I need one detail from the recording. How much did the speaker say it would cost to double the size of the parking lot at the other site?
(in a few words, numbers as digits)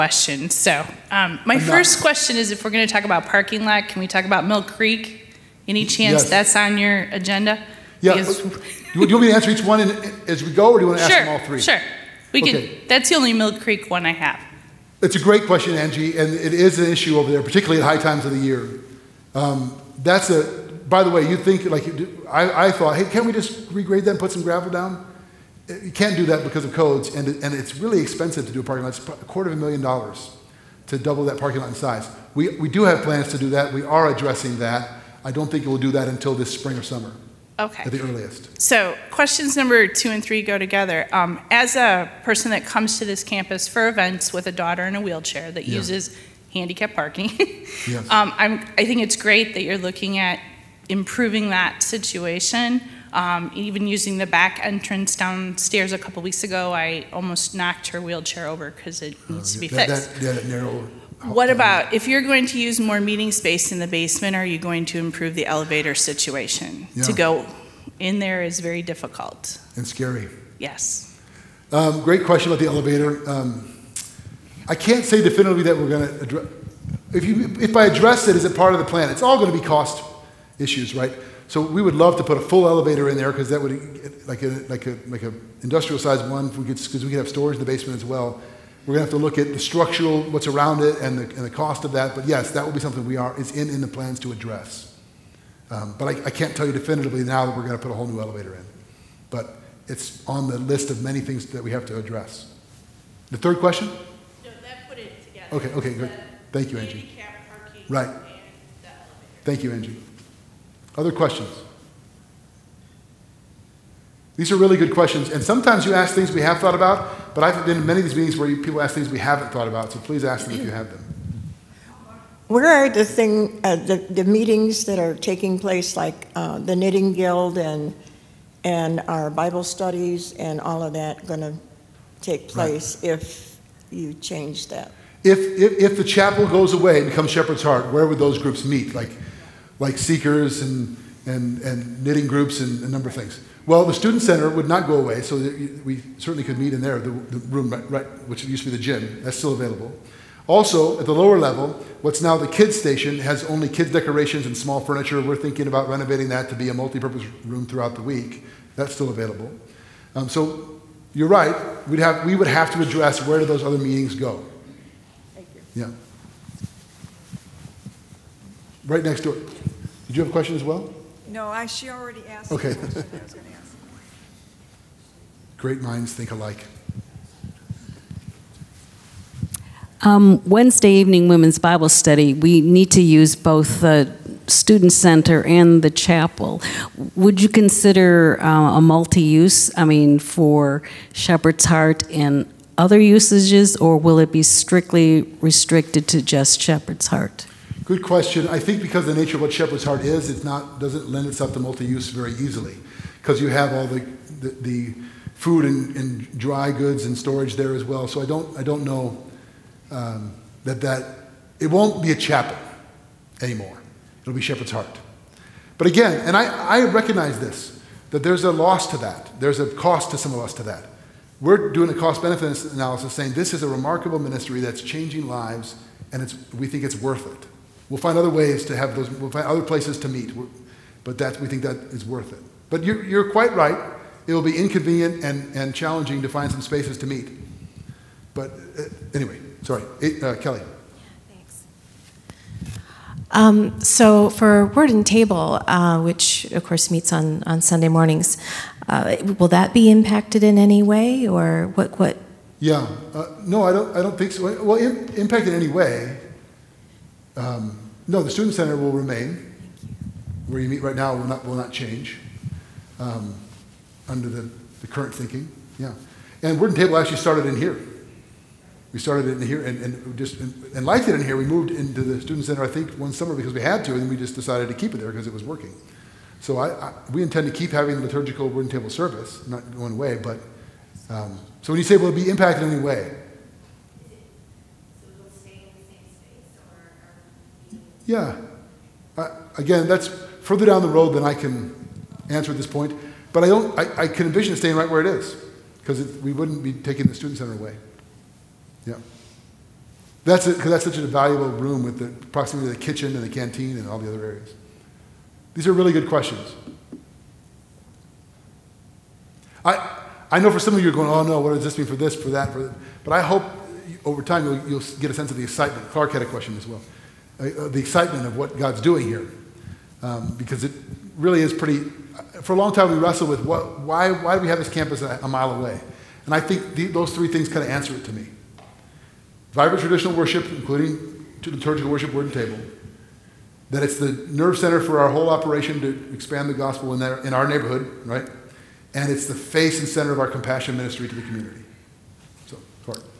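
a quarter of a million dollars.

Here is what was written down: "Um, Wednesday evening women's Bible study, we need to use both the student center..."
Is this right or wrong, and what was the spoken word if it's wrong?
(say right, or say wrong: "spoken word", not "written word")
right.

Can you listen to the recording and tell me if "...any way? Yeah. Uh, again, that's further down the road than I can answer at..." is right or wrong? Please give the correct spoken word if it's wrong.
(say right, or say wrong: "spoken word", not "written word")
right.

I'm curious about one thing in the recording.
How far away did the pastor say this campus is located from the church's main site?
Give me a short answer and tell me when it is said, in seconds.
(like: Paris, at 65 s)
a mile, at 325 s.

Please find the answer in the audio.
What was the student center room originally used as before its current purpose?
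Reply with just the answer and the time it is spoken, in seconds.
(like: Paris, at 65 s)
the gym, at 148 s.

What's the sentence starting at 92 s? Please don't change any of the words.
But yes, that will be something we are, is in, in the plans to address.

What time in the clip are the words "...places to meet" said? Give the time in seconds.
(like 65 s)
229 s.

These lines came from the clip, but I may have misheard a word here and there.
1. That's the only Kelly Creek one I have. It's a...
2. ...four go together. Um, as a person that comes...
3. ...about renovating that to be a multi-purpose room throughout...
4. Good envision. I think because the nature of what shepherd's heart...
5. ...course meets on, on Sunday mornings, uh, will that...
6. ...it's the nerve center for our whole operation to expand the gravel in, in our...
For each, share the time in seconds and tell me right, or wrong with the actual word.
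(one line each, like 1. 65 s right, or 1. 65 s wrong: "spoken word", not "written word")
1. 12 s wrong: "Mill", not "Kelly"
2. 40 s wrong: "three", not "four"
3. 155 s right
4. 197 s wrong: "question", not "envision"
5. 246 s right
6. 333 s wrong: "gospel", not "gravel".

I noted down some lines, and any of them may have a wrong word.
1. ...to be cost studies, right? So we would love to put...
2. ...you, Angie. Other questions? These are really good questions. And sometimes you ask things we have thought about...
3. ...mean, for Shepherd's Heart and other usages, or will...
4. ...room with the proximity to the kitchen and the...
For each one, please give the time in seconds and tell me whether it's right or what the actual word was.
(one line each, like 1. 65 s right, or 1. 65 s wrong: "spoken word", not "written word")
1. 79 s wrong: "issues", not "studies"
2. 109 s right
3. 189 s right
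4. 301 s right.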